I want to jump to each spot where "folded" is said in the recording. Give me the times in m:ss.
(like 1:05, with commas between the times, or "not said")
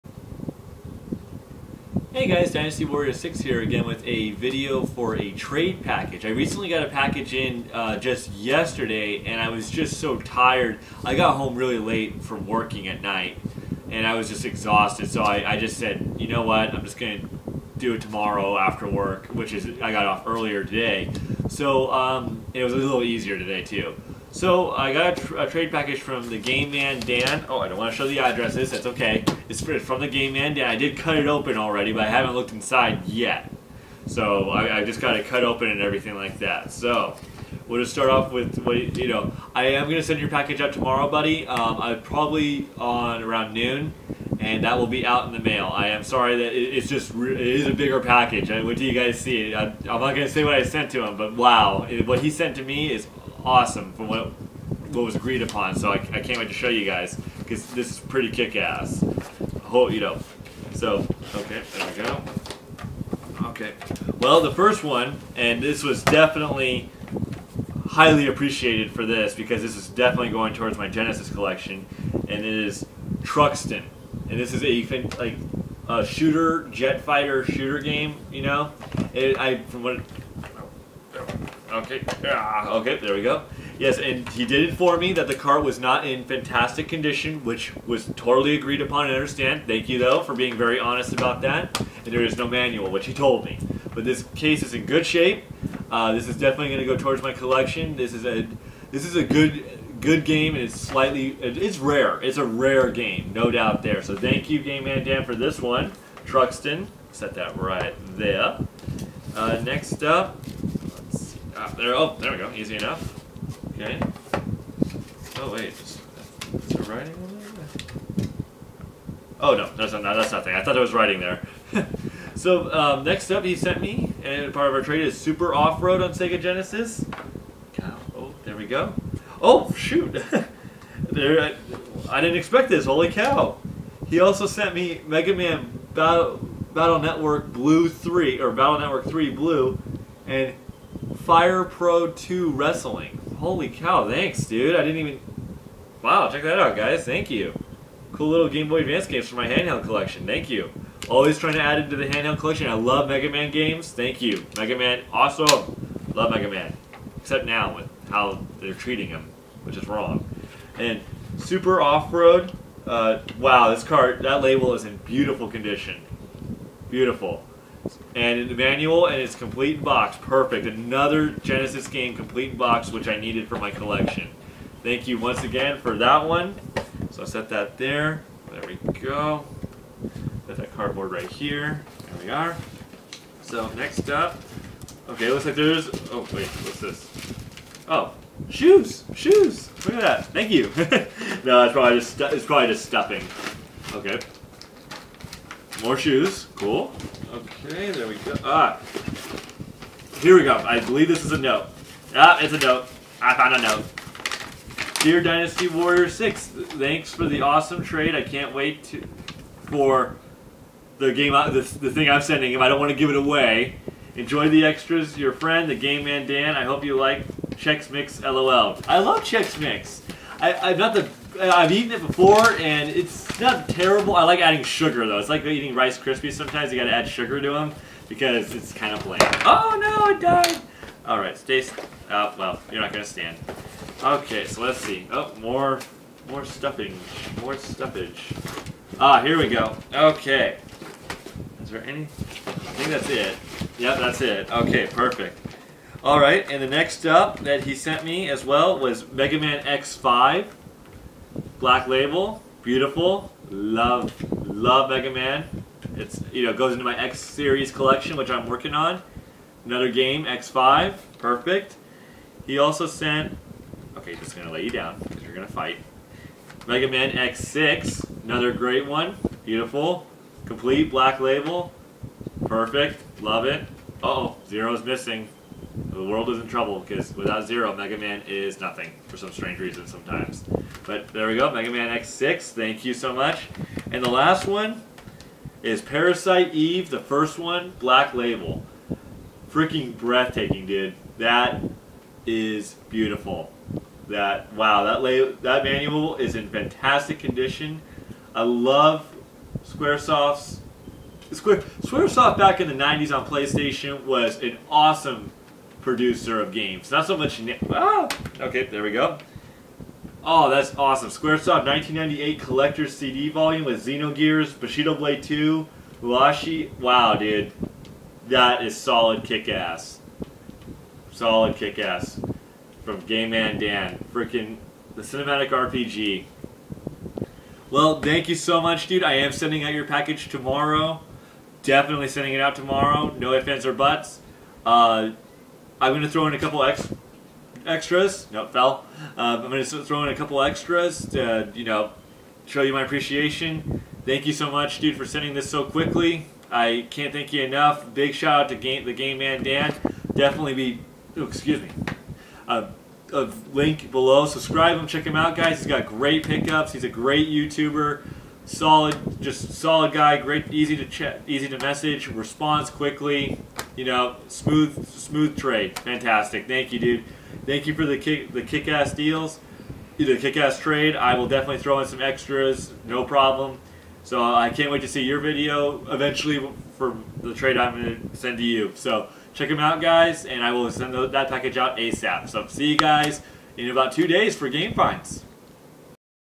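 not said.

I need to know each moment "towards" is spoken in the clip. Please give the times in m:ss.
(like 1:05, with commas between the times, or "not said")
1:10, 1:36.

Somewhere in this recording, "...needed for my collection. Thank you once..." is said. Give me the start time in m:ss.
2:53.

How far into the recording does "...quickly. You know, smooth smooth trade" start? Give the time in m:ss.
6:02.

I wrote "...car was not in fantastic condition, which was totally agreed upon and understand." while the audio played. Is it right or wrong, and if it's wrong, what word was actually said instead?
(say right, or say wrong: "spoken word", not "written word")
right.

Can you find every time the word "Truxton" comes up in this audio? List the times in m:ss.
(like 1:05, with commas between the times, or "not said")
1:13, 1:46.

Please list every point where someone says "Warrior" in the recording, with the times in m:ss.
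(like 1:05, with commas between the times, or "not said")
0:02, 3:25.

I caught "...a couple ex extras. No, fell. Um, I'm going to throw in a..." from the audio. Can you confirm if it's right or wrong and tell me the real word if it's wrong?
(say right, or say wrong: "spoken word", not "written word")
right.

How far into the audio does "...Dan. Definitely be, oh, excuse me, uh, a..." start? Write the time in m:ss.
5:49.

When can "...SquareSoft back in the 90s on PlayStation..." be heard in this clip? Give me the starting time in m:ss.
5:01.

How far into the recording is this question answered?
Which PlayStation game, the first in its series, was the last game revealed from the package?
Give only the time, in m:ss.
4:45.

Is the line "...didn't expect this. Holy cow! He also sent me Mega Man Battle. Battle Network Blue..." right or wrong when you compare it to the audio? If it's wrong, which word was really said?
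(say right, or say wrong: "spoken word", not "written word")
right.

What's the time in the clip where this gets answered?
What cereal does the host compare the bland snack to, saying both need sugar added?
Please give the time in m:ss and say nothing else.
3:45.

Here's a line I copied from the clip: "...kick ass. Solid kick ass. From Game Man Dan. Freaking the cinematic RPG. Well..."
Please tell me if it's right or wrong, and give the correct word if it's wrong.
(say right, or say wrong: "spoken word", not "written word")
right.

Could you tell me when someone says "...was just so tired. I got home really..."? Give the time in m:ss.
0:09.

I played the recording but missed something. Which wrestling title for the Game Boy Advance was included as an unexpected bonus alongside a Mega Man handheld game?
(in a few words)
Fire Pro 2 Wrestling.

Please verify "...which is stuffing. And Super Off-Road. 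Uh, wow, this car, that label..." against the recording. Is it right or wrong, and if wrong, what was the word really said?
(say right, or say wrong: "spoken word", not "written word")
wrong: "wrong", not "stuffing".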